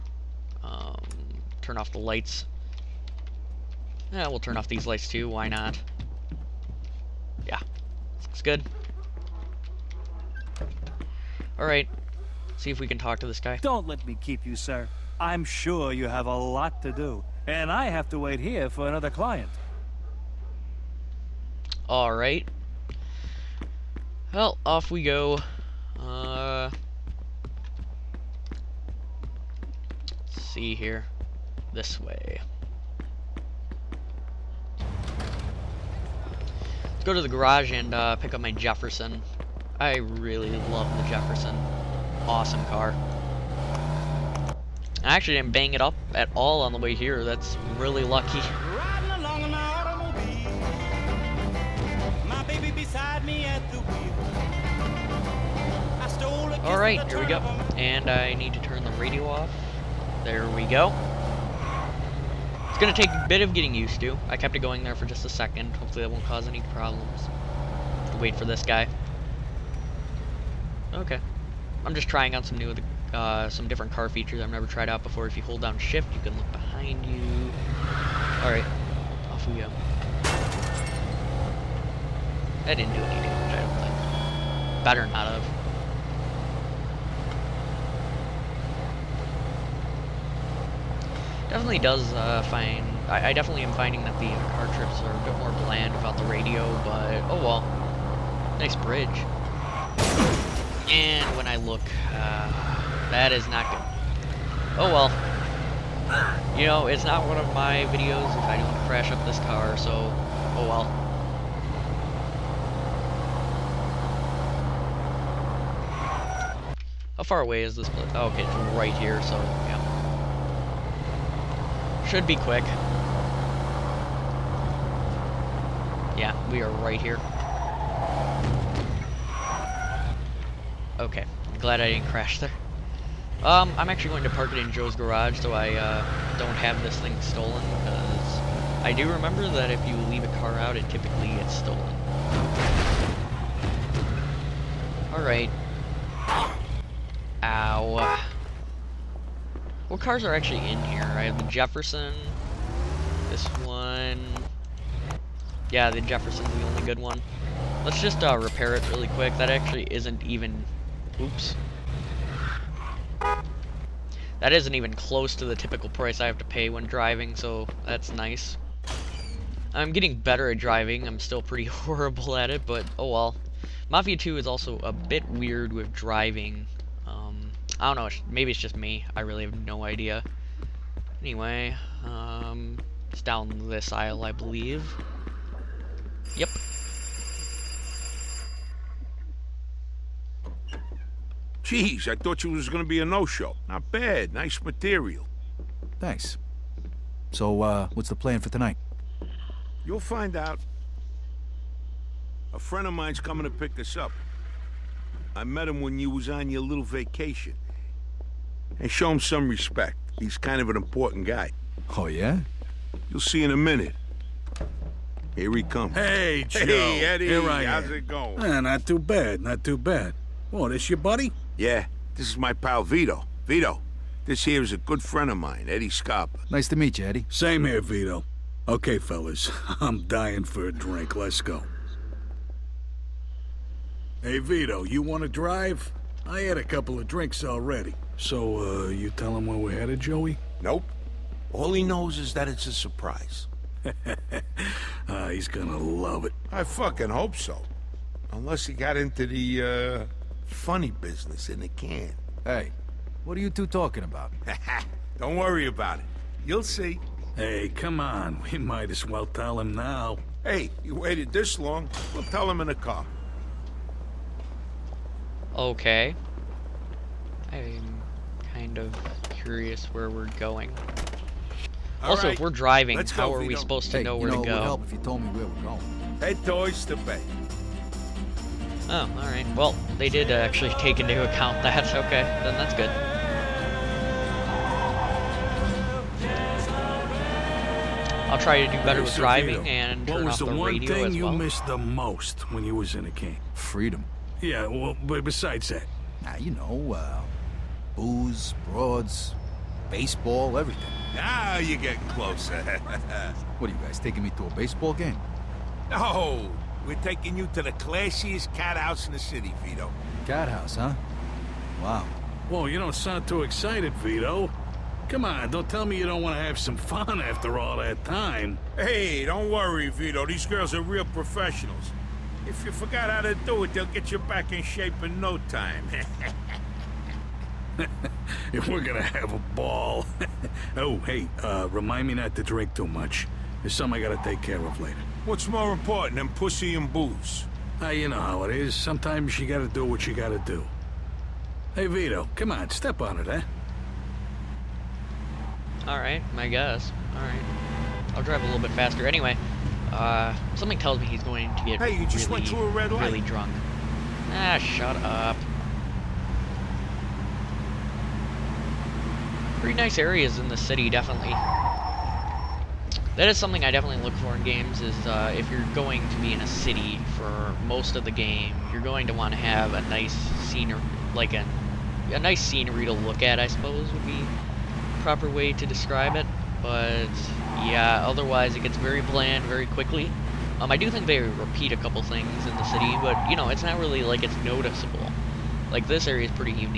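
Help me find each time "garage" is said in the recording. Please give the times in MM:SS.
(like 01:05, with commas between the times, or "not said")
00:37, 02:14.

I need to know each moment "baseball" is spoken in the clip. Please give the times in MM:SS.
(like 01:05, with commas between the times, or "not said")
04:59, 05:04.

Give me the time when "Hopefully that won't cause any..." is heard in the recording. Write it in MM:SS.
01:05.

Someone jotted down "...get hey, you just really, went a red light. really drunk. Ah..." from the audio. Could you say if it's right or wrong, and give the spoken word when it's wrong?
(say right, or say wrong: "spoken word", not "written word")
right.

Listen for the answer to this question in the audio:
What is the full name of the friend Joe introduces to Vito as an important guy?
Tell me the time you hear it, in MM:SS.
03:45.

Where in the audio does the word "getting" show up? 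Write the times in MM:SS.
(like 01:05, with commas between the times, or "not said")
01:03, 02:49, 05:01.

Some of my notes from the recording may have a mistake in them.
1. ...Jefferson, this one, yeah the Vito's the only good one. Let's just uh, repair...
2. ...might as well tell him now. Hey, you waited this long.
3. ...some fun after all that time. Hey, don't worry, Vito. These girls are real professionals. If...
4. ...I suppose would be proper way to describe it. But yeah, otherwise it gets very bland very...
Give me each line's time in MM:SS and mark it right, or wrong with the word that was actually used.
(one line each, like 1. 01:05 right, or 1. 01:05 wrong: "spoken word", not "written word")
1. 02:31 wrong: "Jefferson", not "Vito"
2. 04:18 right
3. 05:16 right
4. 06:13 right.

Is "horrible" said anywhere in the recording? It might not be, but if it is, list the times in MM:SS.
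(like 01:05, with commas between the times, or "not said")
02:51.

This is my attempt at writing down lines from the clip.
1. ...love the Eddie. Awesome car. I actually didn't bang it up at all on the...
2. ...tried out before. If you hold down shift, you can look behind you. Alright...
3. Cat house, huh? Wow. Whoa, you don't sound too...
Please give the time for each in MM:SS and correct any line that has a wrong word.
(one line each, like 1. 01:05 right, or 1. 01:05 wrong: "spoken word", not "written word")
1. 00:40 wrong: "Jefferson", not "Eddie"
2. 01:14 right
3. 05:10 right.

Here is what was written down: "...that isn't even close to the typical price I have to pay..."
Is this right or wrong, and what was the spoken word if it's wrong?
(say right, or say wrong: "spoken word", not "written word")
right.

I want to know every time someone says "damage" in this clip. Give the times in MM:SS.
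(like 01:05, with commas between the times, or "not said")
01:23.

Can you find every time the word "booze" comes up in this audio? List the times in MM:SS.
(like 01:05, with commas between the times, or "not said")
04:57, 05:36.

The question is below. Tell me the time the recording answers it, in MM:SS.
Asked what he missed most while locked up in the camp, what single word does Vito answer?
04:53.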